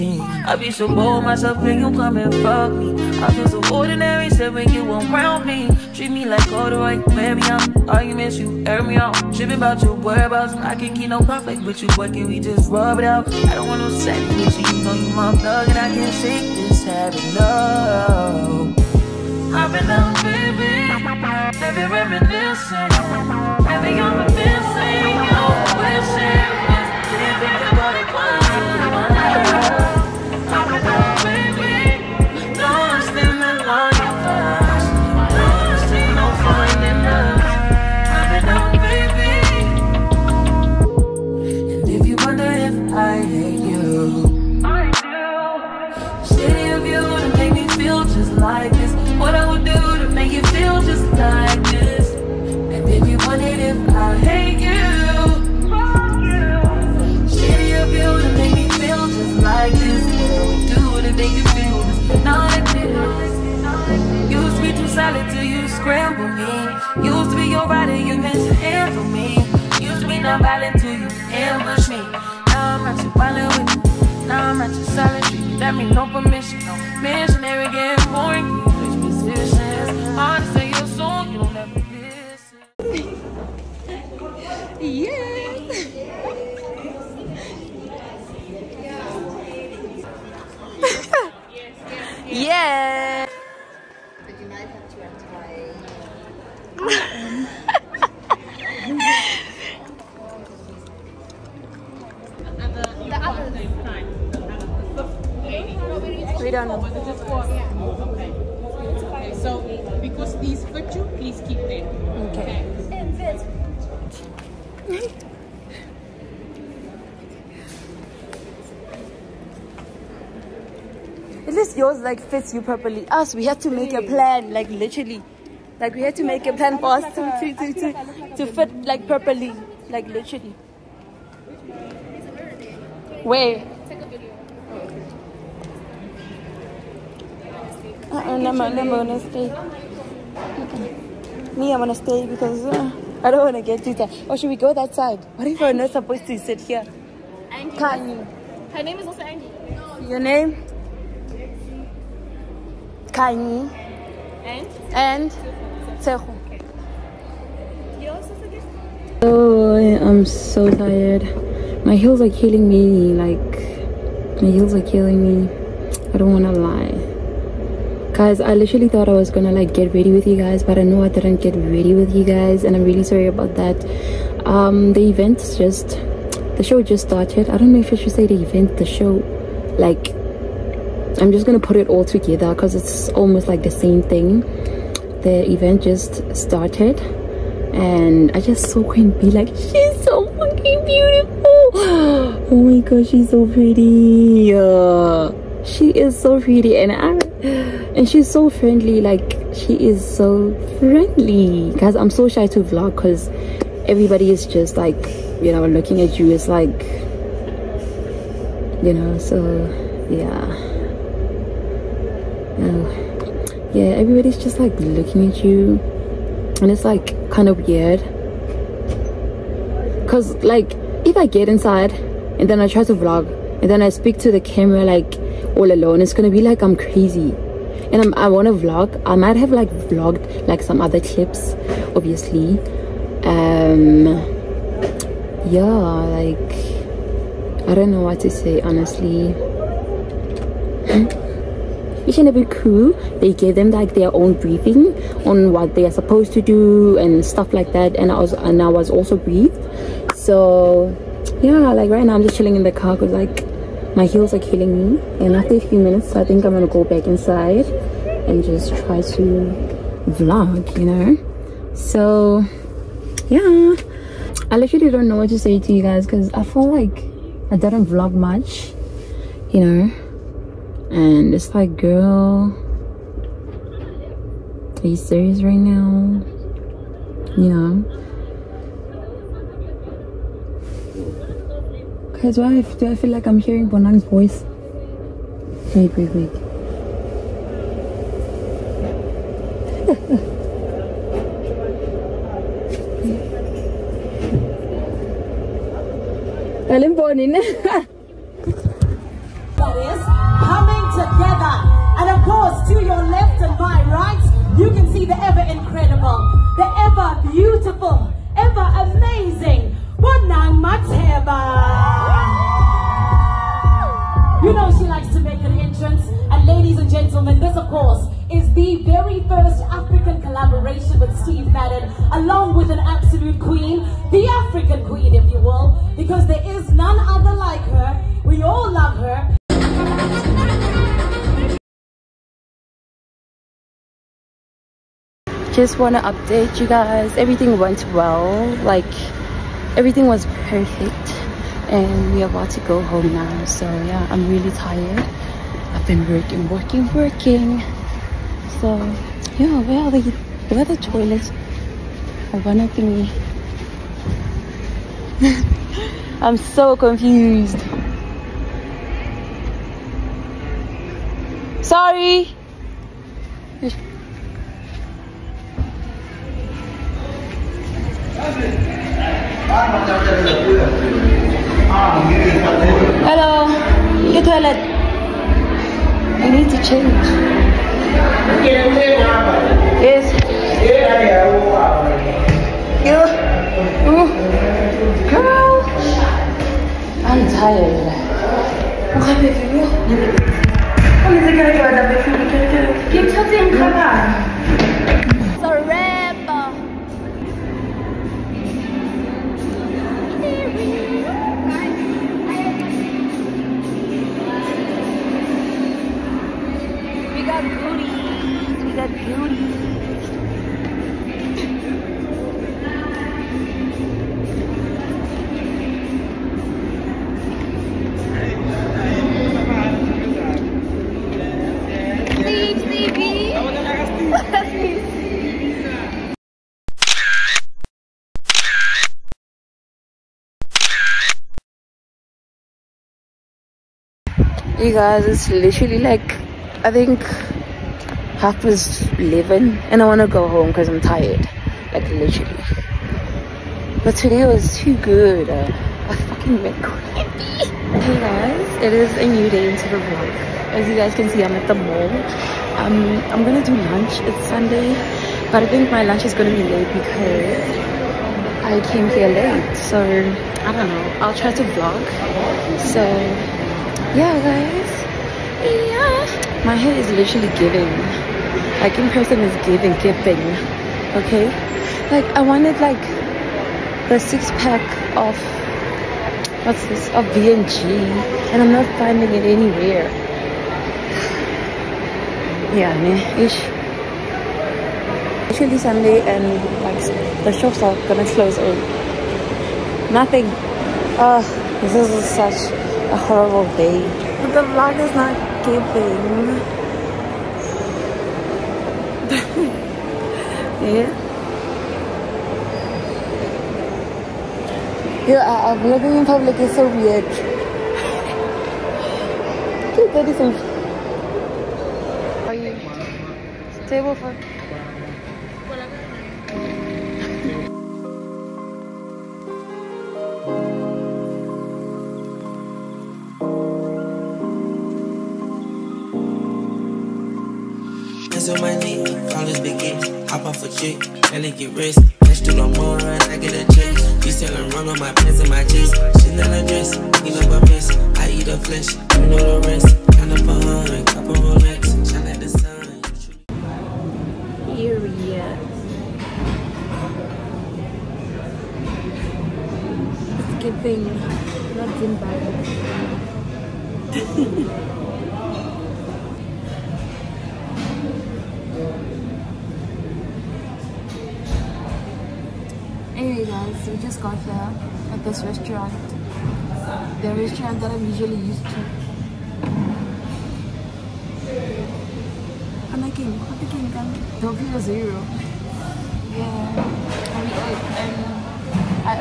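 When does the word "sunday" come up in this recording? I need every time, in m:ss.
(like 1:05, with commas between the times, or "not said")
7:34, 8:05.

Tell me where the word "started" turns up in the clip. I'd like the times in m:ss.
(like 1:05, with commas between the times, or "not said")
2:57, 3:06.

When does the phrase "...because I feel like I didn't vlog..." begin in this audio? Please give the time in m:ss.
4:26.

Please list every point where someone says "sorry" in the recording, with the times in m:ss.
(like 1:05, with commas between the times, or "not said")
2:53, 6:01.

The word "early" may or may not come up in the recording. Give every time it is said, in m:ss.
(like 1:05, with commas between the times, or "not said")
8:08.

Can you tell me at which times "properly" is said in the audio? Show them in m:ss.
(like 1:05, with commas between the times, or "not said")
2:02, 2:09.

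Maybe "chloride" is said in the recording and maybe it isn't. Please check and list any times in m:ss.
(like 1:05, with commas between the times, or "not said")
not said.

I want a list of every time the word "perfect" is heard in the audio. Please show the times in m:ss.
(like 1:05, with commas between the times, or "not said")
5:40.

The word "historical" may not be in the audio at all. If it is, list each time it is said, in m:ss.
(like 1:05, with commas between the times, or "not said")
not said.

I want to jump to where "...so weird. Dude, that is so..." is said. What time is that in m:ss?
8:26.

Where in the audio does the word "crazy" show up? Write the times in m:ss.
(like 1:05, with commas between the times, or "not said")
3:46, 7:26.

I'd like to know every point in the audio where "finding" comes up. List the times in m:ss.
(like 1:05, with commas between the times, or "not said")
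7:58.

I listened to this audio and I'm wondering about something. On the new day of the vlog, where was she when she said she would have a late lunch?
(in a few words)
the mall.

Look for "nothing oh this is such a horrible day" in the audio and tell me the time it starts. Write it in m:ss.
8:10.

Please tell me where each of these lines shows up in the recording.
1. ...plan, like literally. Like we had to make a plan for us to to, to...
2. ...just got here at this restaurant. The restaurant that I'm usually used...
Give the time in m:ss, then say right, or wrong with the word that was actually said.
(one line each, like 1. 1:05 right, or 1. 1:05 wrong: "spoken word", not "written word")
1. 2:04 right
2. 9:23 right.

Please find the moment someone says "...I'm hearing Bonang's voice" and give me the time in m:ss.
4:43.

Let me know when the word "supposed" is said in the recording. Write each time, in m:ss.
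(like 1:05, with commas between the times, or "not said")
2:25, 4:05.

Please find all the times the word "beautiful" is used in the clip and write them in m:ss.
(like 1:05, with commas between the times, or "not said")
3:10, 5:07.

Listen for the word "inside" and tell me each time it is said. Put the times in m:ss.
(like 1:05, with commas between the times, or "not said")
3:41, 4:17.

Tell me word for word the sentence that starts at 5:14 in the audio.
You know she likes to make an entrance.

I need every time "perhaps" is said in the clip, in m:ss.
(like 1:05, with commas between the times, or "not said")
not said.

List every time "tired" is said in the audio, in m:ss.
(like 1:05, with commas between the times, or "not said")
2:23, 2:40, 5:44, 7:20.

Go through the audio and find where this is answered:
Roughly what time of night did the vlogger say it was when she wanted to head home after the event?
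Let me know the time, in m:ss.
7:18.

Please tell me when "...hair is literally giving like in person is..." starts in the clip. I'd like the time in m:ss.
7:46.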